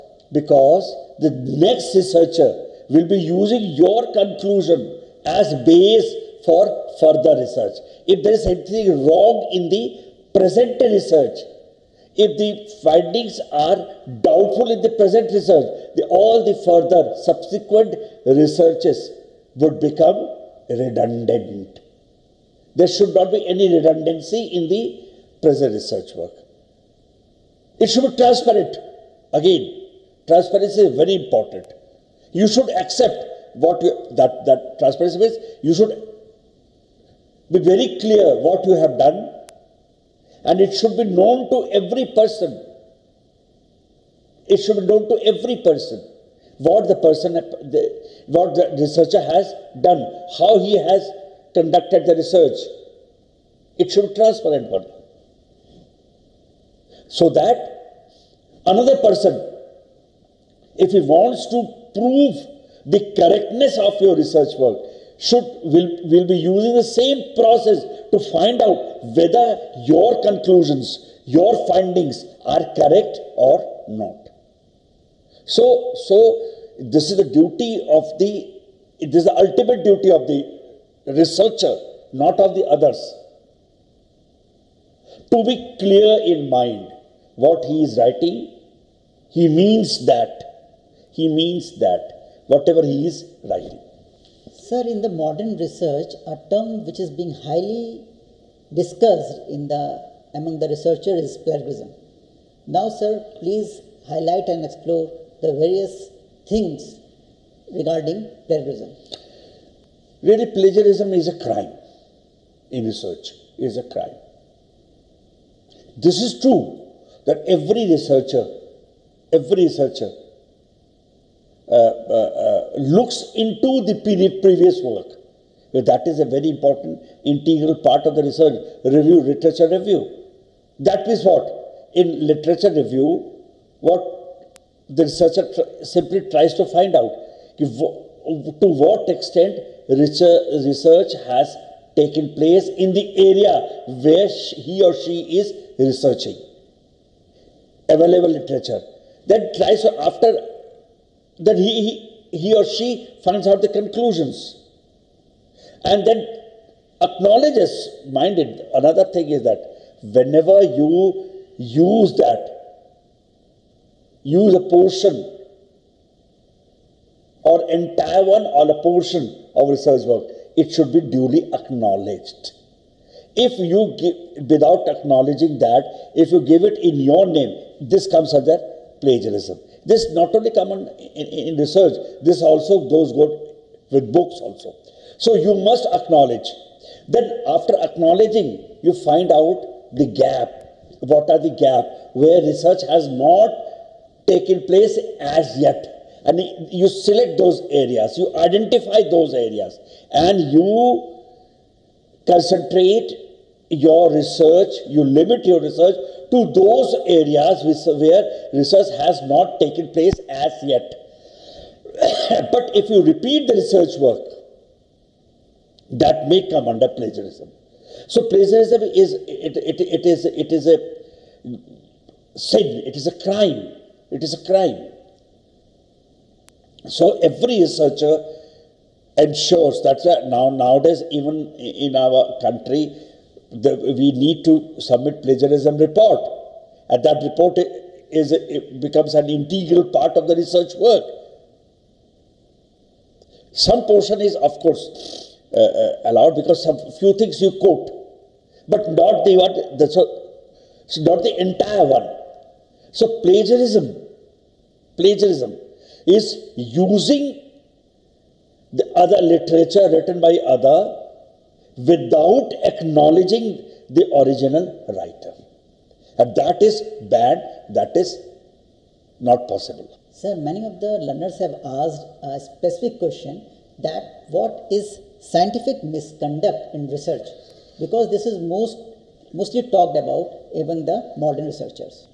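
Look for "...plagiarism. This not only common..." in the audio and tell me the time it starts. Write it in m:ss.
2:59.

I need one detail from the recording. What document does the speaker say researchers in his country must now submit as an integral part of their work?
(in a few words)
Plagiarism report.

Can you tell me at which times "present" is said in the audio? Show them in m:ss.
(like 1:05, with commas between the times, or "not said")
0:10, 0:14, 0:25.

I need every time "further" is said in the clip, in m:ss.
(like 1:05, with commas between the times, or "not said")
0:07, 0:16.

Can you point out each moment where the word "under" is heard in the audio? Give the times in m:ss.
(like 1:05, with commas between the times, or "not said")
2:58, 3:36.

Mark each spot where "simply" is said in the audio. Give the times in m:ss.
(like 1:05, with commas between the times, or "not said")
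2:15.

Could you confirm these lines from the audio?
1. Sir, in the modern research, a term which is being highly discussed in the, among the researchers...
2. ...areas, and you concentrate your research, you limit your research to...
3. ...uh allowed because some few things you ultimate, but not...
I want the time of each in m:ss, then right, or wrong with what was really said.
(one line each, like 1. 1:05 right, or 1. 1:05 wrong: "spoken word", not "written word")
1. 1:34 right
2. 3:19 right
3. 4:05 wrong: "quote", not "ultimate".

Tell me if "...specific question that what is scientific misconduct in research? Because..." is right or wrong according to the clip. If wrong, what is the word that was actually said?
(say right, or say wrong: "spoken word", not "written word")
right.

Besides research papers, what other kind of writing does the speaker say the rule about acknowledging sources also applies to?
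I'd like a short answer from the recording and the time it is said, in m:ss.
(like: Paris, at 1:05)
Books, at 3:04.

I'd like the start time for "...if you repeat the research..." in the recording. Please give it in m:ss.
3:32.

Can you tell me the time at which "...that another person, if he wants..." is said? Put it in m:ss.
0:57.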